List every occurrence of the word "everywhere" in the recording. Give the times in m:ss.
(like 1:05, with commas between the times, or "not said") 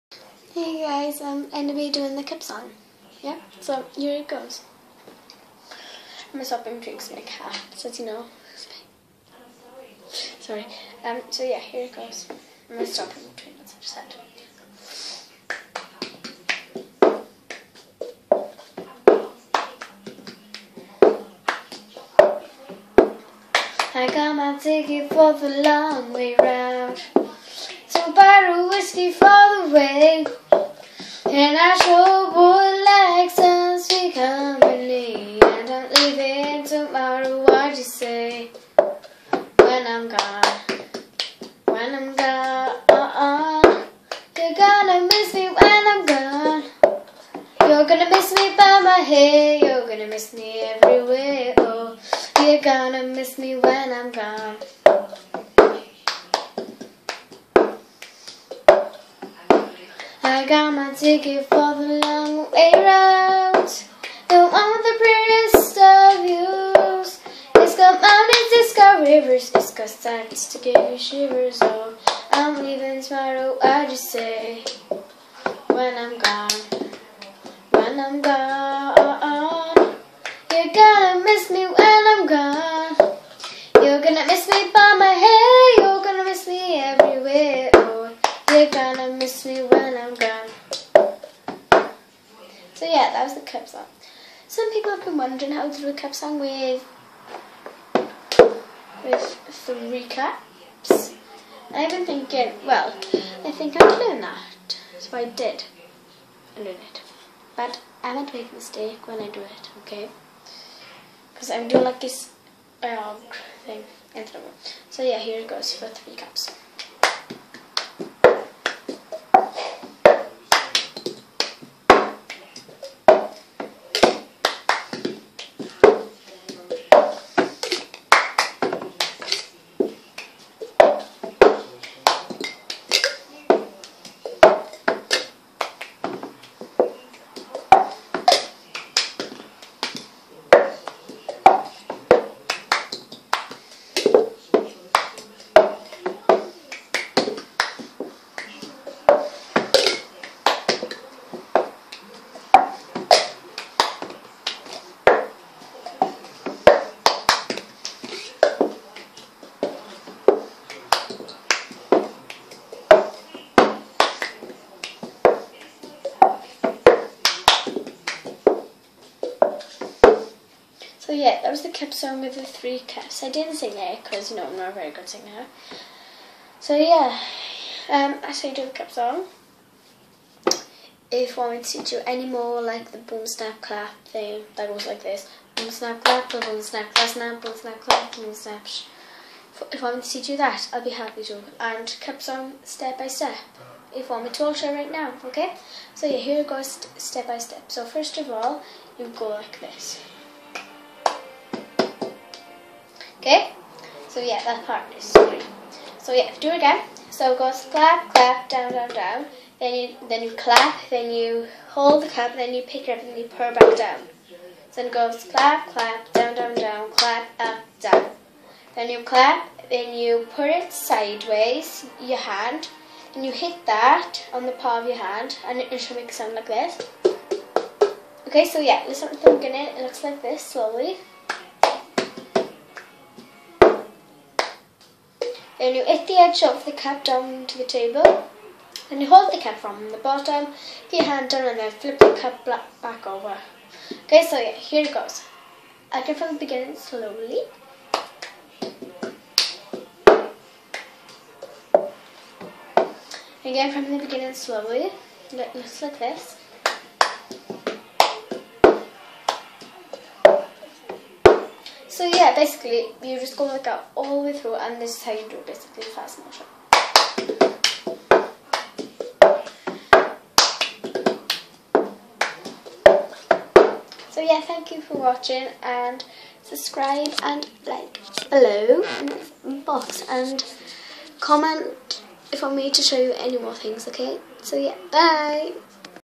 0:50, 1:26.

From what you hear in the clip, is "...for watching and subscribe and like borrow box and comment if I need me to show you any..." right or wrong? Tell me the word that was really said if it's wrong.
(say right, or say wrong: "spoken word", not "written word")
wrong: "below", not "borrow".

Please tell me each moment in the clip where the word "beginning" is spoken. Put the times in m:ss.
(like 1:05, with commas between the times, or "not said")
4:06, 4:14.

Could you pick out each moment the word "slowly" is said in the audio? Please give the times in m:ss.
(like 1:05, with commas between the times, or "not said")
3:50, 4:06, 4:14.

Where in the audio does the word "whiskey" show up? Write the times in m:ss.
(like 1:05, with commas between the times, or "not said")
0:28.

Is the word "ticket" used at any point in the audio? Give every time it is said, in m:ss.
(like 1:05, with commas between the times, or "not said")
0:24, 1:00.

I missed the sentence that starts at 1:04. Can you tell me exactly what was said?
The one with the prettiest of views.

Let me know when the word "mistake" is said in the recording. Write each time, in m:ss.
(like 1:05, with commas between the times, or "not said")
1:48.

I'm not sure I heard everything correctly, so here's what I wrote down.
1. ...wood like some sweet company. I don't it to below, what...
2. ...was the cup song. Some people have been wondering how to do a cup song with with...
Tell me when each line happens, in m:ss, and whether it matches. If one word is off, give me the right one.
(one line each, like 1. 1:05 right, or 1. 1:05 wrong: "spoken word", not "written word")
1. 0:32 wrong: "tomorrow", not "below"
2. 1:33 right.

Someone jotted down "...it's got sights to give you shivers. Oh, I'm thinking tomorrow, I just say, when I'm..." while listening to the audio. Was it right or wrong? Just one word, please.
wrong.